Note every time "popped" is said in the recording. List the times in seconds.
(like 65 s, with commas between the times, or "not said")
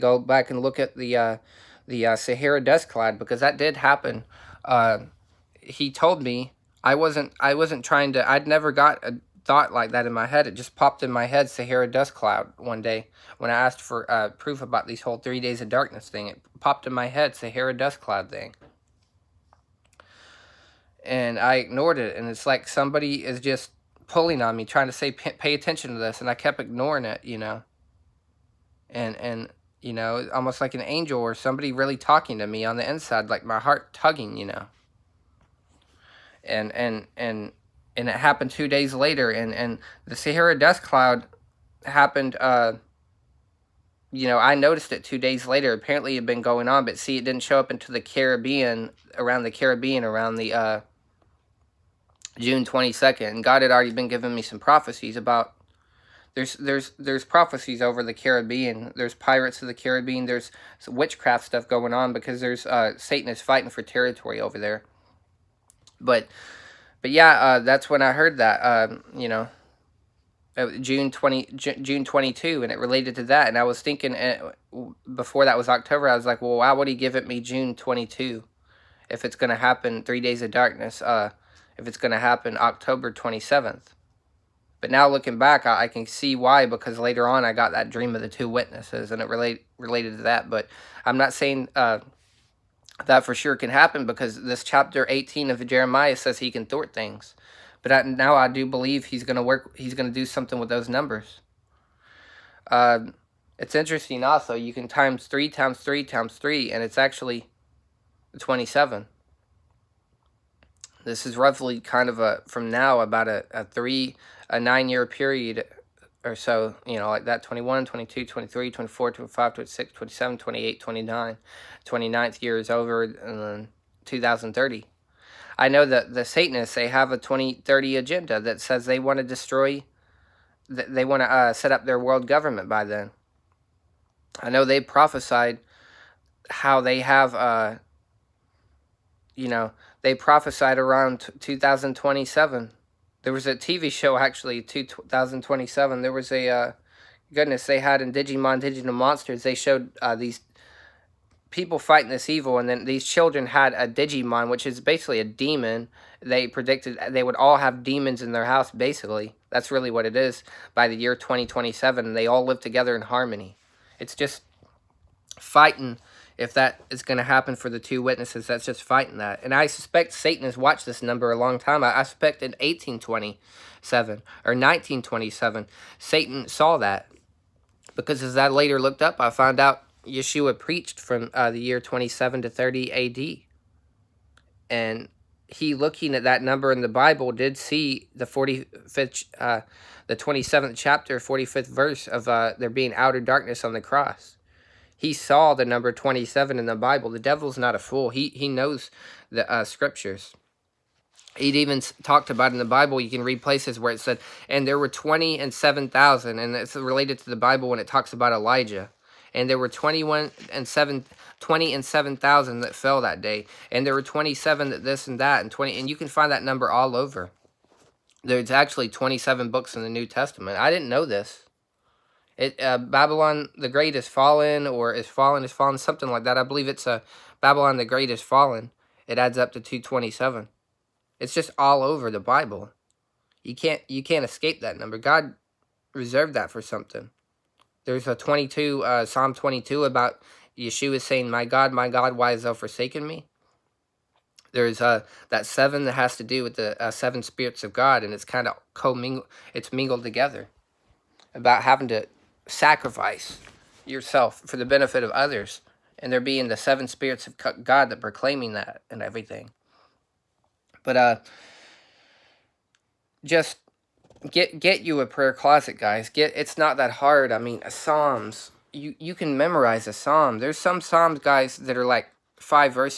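10 s, 16 s.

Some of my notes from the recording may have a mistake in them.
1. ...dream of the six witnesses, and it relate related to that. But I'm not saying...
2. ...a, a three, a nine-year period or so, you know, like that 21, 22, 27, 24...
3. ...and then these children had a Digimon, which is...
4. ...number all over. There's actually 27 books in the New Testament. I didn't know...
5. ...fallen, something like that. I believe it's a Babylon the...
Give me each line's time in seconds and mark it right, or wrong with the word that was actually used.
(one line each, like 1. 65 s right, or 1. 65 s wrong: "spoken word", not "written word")
1. 87 s wrong: "two", not "six"
2. 113 s wrong: "23", not "27"
3. 152 s right
4. 216 s right
5. 225 s right.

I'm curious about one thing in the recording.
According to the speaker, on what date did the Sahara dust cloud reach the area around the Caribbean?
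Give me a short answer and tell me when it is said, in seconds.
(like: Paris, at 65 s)
June 22nd, at 52 s.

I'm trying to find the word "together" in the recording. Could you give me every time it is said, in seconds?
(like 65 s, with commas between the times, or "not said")
162 s, 250 s.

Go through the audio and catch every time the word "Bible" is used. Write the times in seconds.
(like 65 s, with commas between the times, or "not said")
186 s, 196 s, 202 s, 207 s, 232 s.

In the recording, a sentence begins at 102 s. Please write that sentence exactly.
Uh, it's interesting also, you can times 3 times 3 times 3, and it's actually 27.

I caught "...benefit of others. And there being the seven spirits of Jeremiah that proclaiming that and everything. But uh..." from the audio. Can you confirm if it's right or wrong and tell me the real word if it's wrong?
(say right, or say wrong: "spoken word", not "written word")
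wrong: "God", not "Jeremiah".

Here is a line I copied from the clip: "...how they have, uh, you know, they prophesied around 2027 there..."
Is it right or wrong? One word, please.
right.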